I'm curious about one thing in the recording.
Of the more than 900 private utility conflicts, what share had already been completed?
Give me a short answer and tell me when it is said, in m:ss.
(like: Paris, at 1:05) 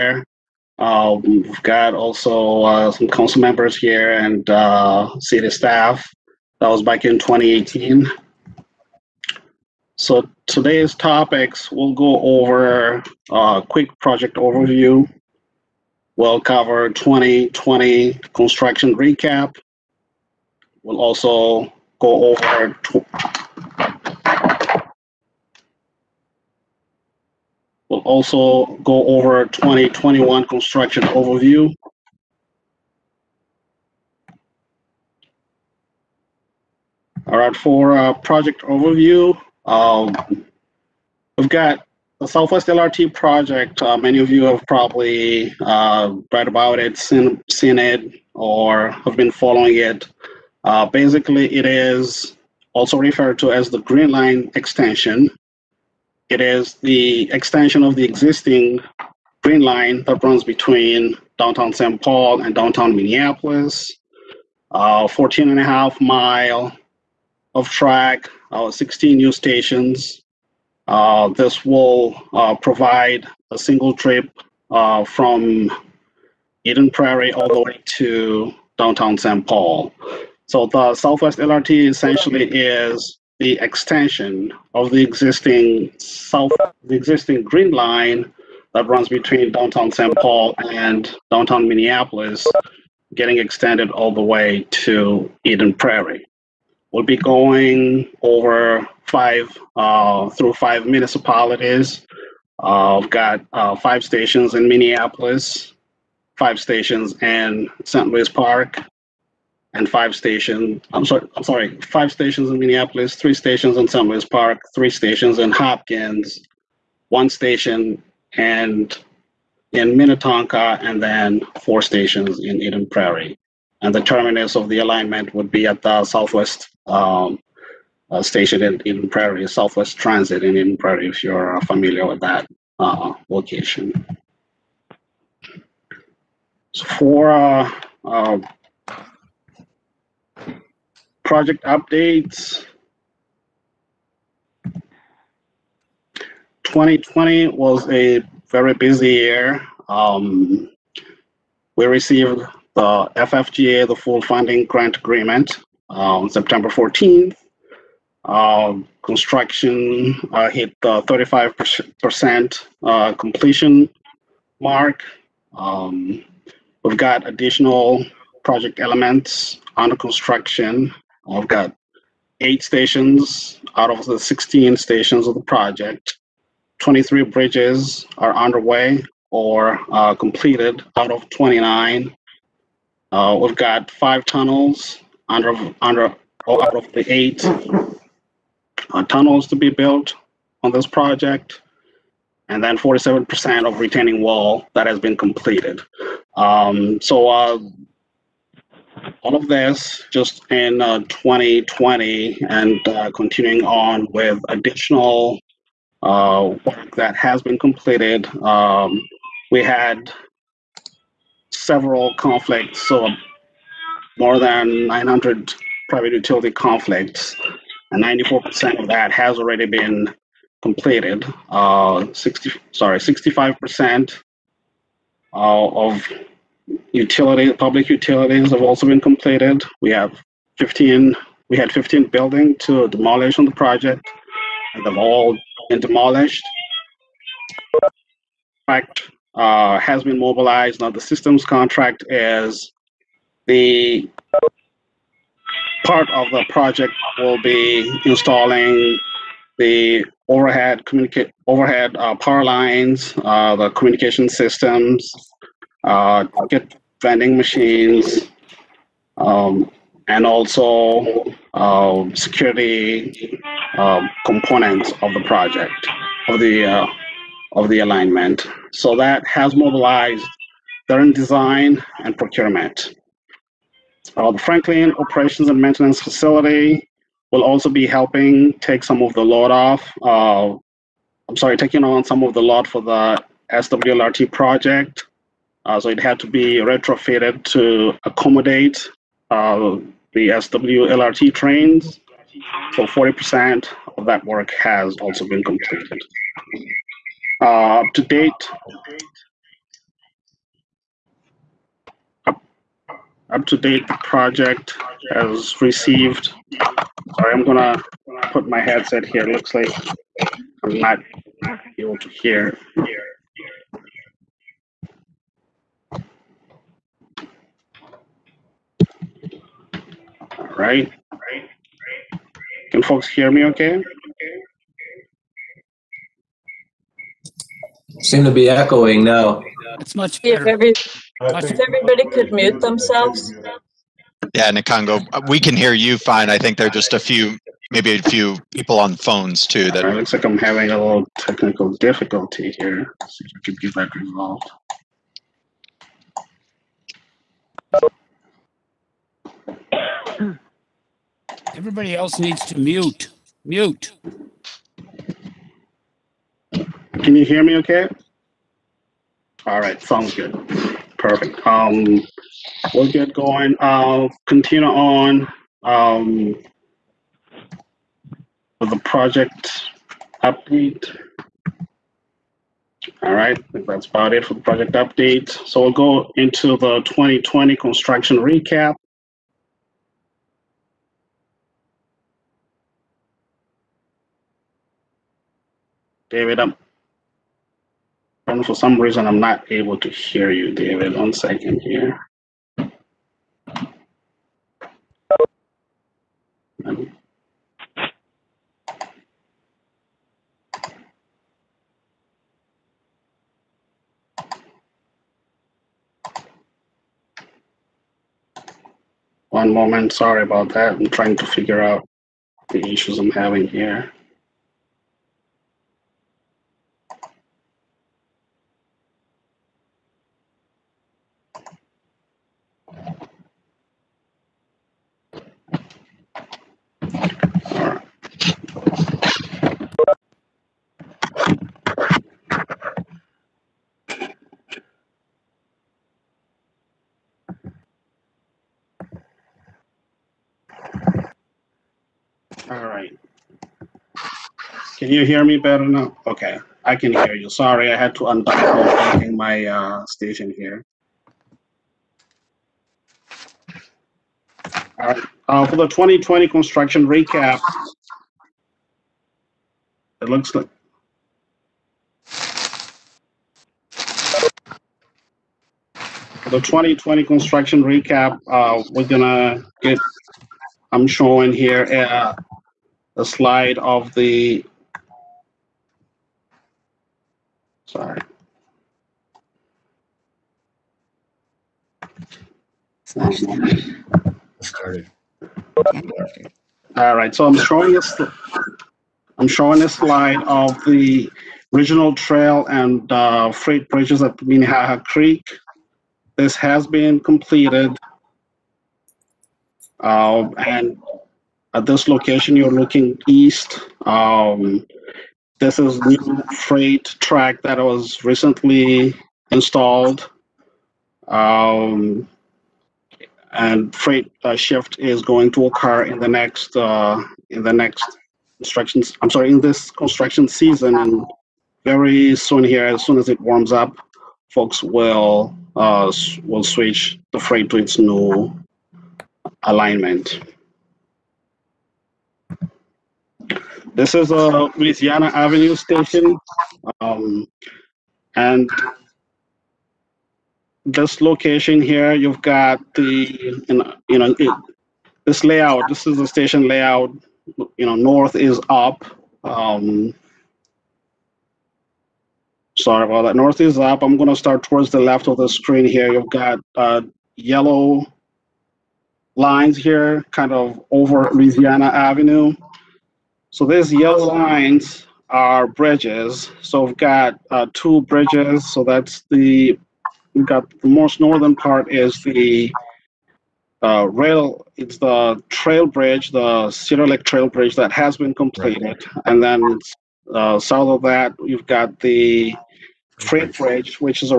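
94%, at 3:38.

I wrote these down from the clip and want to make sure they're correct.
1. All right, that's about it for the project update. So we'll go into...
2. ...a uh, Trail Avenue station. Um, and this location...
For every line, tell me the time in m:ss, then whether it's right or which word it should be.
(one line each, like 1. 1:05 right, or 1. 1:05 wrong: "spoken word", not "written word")
1. 6:13 right
2. 8:54 wrong: "Louisiana", not "Trail".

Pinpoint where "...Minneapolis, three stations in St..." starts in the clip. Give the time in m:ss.
1:52.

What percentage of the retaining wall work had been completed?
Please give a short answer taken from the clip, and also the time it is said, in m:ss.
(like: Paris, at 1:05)
47%, at 3:12.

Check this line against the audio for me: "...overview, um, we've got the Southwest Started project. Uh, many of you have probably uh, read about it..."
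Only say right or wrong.
wrong.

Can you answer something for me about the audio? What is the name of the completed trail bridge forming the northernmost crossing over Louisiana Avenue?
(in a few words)
Cedar Lake Trail Bridge.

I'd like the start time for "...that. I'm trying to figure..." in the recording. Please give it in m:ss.
6:50.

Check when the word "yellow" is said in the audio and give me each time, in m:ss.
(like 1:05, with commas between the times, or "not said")
9:17, 9:23.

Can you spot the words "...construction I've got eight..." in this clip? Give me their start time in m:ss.
2:49.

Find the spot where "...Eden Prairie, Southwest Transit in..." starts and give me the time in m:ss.
2:08.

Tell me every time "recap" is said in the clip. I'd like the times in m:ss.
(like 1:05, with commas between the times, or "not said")
0:18, 6:18, 7:36, 7:47.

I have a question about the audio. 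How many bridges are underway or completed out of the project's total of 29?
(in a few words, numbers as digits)
23.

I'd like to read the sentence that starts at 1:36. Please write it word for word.
We'll be going over five uh, through five municipalities.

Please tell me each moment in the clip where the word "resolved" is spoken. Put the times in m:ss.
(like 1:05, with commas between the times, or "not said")
5:43.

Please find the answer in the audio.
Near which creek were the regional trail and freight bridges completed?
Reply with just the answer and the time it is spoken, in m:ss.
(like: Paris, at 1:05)
Minnehaha Creek, at 8:14.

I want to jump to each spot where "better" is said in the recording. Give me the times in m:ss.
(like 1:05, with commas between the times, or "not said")
7:25.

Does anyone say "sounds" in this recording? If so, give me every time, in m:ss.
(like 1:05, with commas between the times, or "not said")
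5:59.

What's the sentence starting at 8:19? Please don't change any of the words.
Uh, and at this location, you're looking east.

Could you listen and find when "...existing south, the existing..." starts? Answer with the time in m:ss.
1:25.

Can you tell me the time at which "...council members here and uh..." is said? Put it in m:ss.
0:03.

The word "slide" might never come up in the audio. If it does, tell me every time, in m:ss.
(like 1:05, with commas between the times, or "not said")
7:53, 8:09.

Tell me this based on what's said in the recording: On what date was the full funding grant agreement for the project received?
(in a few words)
September 14th.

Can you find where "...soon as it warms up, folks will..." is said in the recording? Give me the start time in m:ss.
8:42.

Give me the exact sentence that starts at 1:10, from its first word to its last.
Uh, this will uh, provide a single trip uh, from Eden Prairie all the way to downtown St.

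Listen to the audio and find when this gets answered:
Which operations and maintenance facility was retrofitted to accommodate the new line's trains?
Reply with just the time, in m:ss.
4:34.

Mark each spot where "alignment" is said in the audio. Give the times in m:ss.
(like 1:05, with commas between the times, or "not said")
2:04, 4:27, 8:49.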